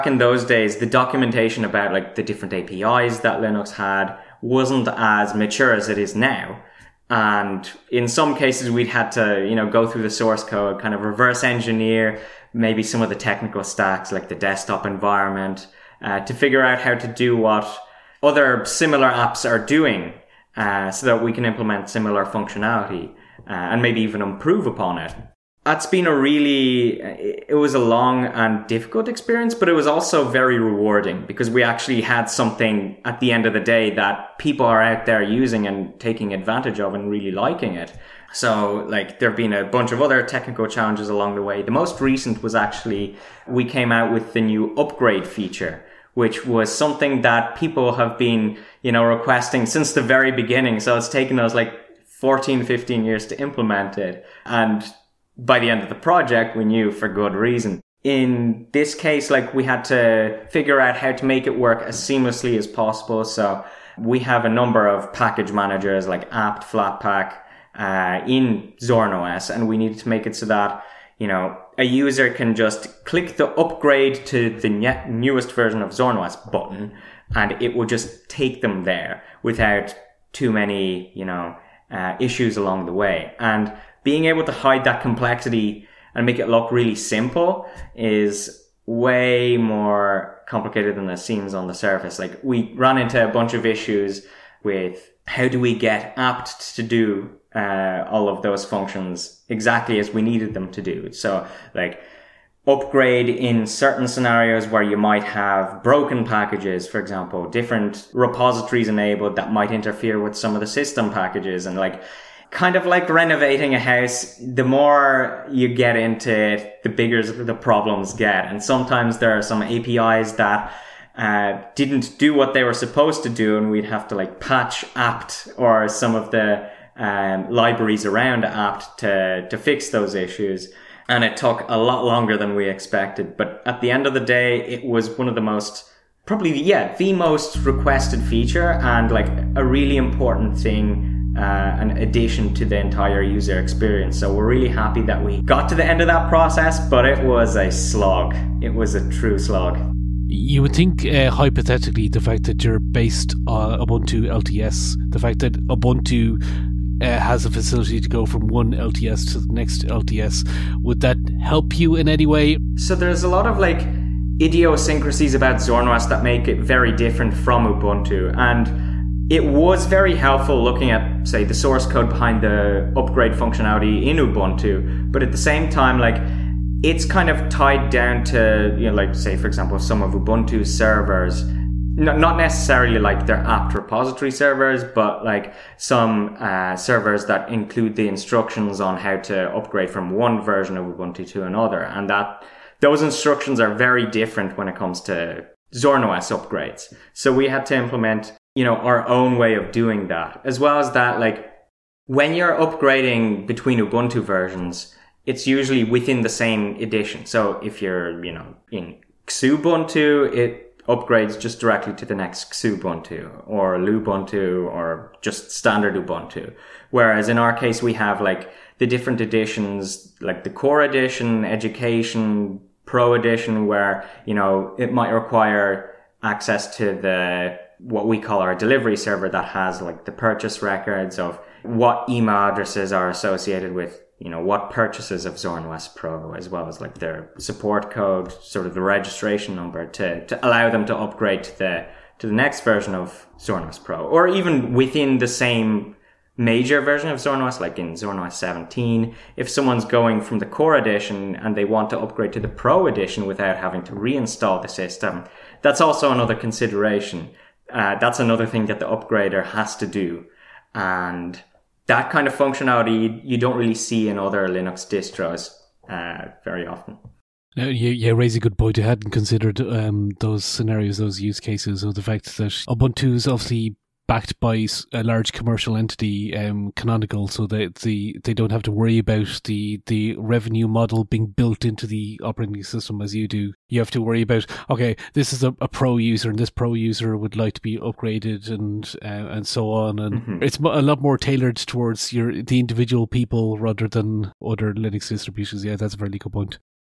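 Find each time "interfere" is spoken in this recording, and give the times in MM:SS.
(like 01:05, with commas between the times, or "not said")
01:49.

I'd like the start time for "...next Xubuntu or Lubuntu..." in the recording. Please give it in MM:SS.
03:32.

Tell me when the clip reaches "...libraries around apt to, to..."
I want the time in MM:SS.
02:07.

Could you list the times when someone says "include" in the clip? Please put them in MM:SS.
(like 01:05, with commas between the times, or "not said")
03:07.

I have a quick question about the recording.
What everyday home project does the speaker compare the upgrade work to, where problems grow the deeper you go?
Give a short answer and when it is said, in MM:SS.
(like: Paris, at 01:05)
renovating a house, at 01:53.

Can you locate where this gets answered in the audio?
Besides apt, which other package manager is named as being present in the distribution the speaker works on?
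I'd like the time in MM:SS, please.
01:06.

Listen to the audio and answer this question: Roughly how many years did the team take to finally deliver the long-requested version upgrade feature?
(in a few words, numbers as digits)
14 15 years.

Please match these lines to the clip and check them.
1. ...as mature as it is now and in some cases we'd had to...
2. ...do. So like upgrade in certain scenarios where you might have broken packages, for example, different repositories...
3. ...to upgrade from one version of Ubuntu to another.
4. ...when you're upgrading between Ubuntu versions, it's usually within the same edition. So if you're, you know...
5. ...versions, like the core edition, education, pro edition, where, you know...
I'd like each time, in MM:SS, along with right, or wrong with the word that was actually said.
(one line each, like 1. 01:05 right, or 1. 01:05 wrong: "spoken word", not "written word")
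1. 00:04 right
2. 01:40 right
3. 03:09 right
4. 03:22 right
5. 03:39 wrong: "editions", not "versions".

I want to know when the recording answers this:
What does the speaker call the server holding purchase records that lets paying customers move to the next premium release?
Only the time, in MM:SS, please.
03:48.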